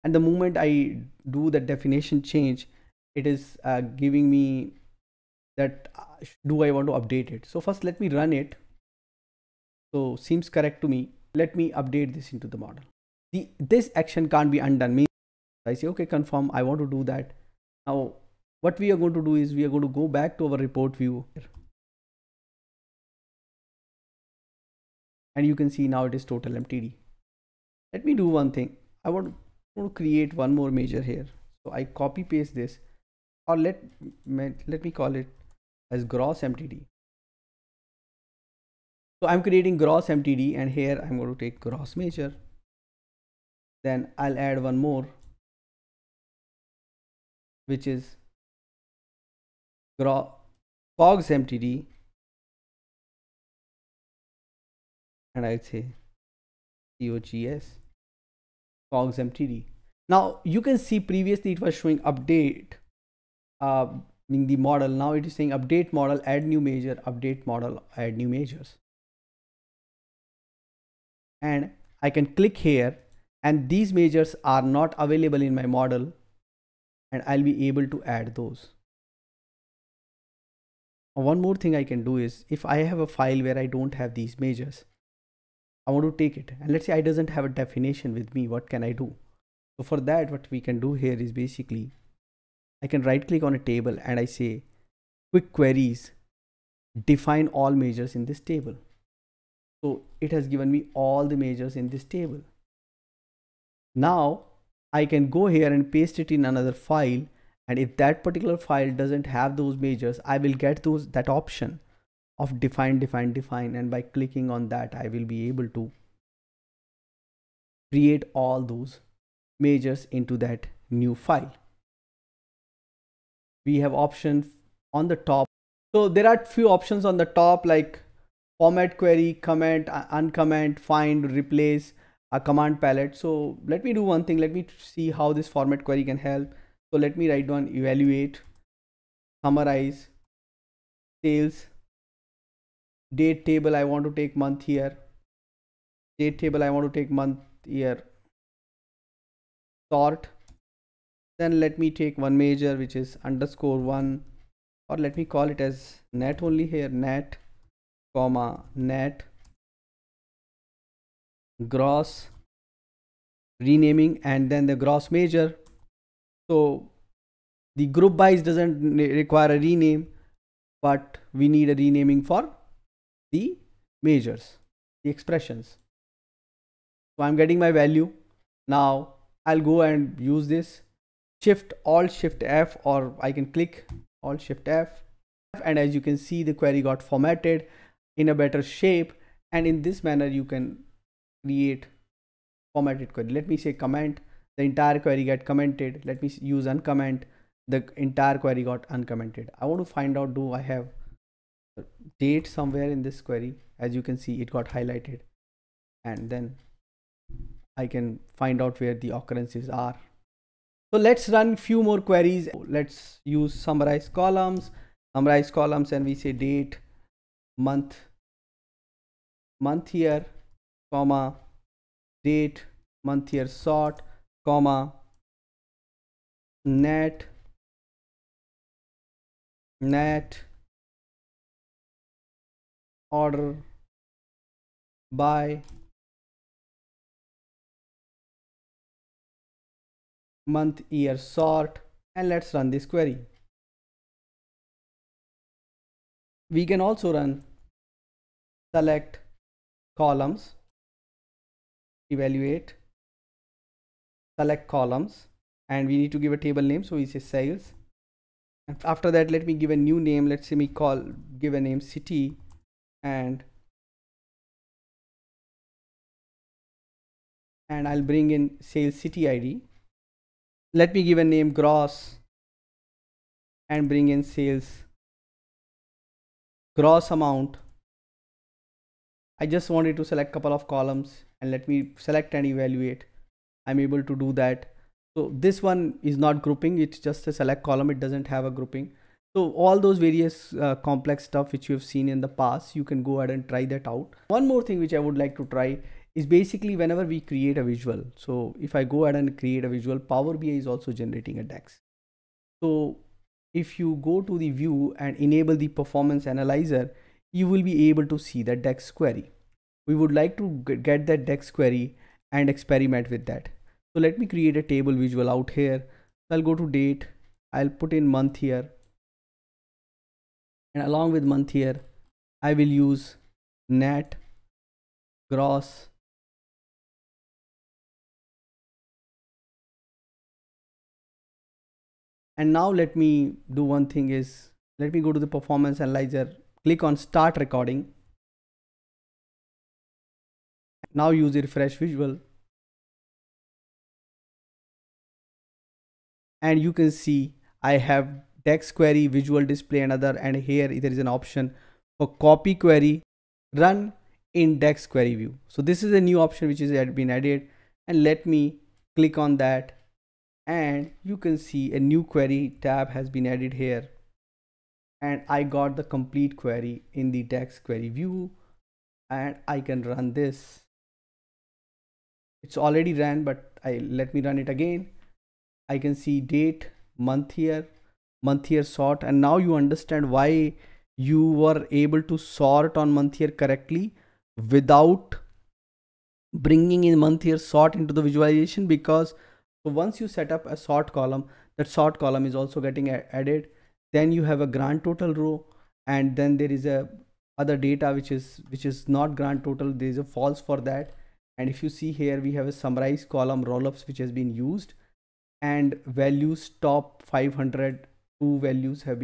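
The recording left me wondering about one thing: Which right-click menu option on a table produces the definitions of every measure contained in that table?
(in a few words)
Define all measures in this table.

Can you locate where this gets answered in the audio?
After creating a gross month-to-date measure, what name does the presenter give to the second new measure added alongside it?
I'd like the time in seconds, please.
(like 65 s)
49 s.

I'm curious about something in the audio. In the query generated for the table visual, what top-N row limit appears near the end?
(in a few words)
500.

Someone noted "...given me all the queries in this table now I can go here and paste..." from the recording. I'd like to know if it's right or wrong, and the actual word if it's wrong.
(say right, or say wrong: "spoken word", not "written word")
wrong: "measures", not "queries".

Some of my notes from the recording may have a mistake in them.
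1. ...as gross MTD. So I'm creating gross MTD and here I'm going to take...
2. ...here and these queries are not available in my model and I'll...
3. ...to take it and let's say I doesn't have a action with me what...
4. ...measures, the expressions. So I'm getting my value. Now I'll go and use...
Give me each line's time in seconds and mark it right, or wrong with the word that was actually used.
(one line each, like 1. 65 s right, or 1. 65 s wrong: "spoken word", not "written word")
1. 35 s right
2. 72 s wrong: "measures", not "queries"
3. 86 s wrong: "definition", not "action"
4. 174 s right.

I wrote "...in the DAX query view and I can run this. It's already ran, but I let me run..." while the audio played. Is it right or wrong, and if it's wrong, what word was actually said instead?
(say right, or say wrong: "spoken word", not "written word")
right.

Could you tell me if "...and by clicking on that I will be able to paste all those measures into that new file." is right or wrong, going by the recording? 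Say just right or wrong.
wrong.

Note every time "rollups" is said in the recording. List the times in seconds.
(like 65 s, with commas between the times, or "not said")
403 s.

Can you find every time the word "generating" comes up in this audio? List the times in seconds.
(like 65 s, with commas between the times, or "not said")
300 s.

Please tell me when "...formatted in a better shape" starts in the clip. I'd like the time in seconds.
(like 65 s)
187 s.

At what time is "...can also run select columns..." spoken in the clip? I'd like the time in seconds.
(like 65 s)
246 s.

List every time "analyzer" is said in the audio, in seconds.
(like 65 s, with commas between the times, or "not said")
306 s, 335 s.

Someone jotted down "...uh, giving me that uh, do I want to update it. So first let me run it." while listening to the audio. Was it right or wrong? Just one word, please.
right.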